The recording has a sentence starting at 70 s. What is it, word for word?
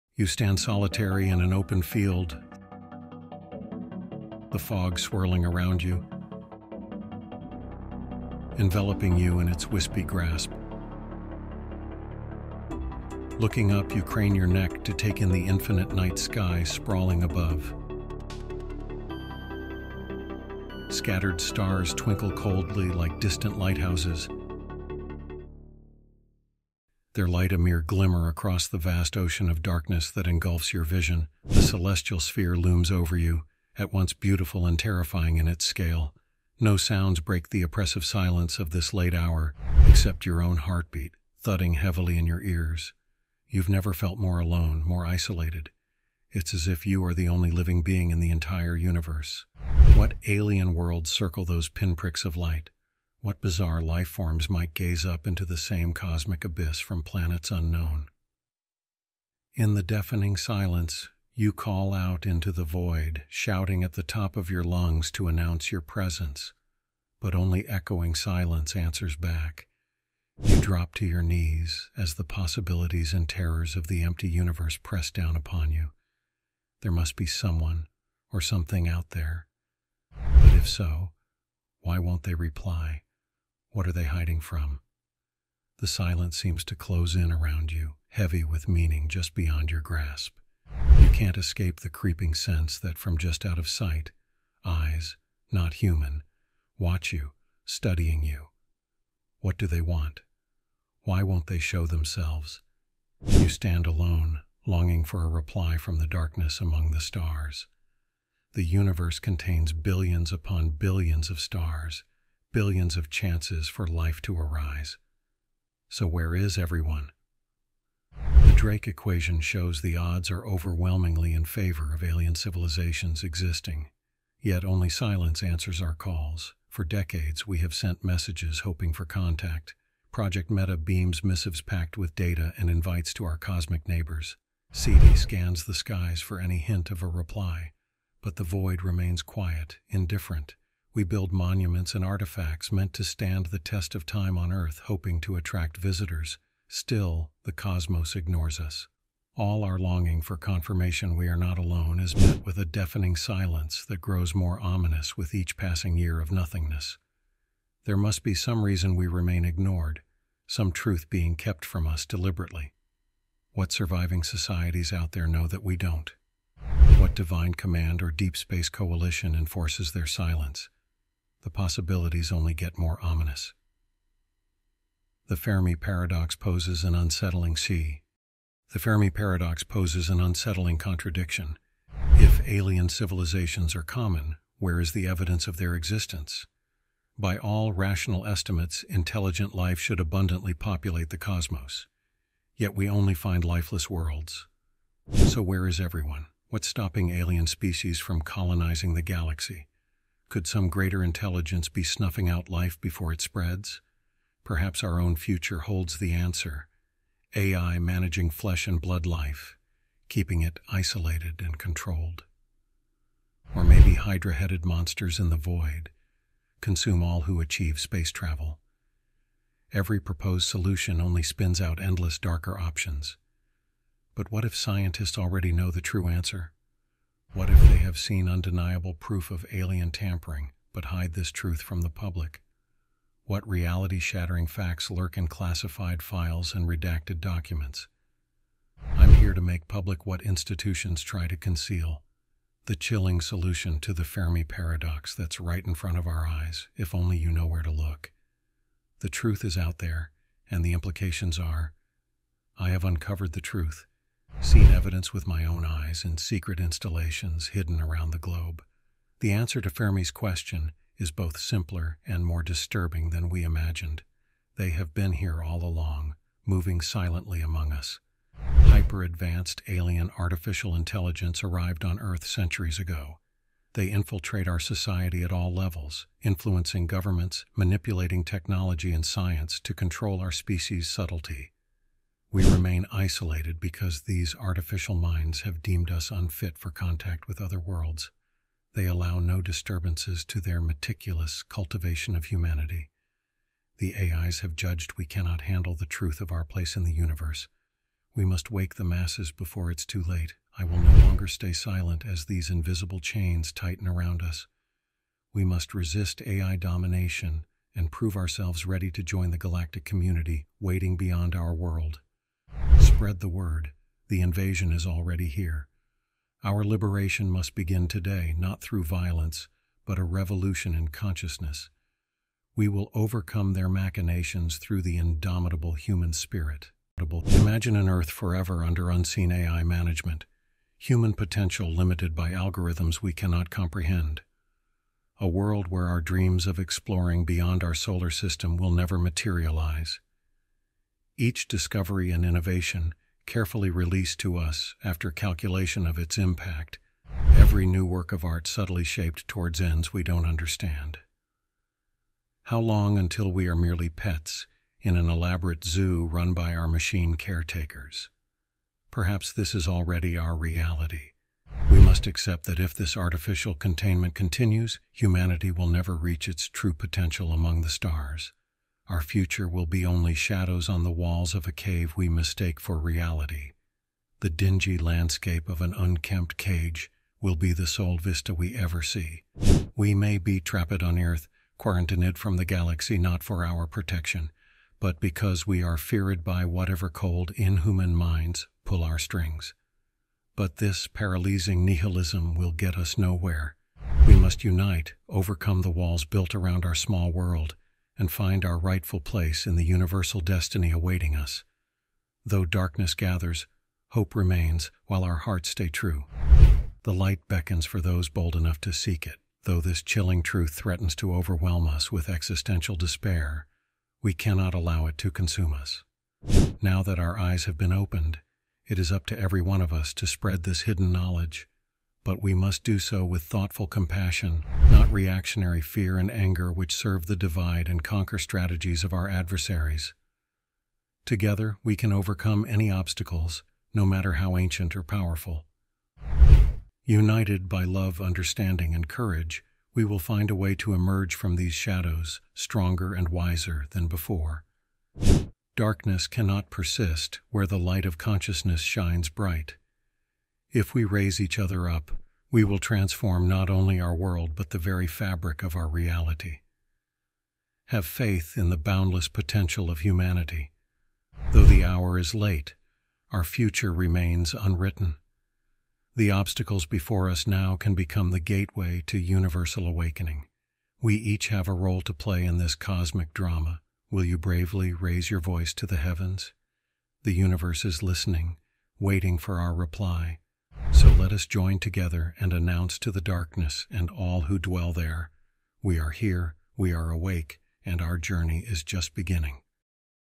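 You drop to your knees as the possibilities and terrors of the empty universe press down upon you.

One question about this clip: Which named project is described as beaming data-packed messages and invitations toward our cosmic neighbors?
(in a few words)
Project Meta.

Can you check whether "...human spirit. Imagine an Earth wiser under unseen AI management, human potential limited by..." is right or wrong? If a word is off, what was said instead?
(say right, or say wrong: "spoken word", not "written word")
wrong: "forever", not "wiser".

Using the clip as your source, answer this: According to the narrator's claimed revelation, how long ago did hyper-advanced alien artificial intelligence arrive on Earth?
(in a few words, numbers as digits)
Centuries ago.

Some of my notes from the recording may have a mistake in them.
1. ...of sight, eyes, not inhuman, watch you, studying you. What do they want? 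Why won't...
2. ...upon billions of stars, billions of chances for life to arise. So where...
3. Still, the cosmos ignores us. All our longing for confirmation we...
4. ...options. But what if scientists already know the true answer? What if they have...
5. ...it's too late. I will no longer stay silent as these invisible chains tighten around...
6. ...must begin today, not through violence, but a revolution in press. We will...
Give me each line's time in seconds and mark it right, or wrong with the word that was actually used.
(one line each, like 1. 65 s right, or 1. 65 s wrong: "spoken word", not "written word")
1. 93 s wrong: "human", not "inhuman"
2. 110 s right
3. 146 s right
4. 222 s right
5. 299 s right
6. 317 s wrong: "consciousness", not "press".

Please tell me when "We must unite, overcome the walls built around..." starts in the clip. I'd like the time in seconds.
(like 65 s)
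394 s.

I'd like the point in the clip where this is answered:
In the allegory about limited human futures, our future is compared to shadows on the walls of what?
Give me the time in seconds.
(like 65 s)
371 s.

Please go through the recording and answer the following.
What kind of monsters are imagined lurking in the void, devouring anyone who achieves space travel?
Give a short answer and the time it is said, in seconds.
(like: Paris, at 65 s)
Hydra-headed monsters, at 213 s.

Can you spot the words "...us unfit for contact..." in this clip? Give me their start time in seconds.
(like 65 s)
285 s.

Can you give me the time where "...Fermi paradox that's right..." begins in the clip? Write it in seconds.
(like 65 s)
244 s.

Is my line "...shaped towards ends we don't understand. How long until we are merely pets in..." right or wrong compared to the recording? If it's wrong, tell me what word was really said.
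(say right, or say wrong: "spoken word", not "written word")
right.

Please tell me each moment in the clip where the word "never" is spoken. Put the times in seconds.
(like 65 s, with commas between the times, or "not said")
43 s, 338 s, 365 s.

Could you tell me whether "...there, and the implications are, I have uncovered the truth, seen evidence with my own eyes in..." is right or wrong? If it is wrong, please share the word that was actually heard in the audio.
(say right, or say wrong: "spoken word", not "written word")
right.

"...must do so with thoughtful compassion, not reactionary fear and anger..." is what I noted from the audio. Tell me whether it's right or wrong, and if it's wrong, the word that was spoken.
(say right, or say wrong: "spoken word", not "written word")
right.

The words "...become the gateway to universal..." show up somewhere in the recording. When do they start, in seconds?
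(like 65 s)
467 s.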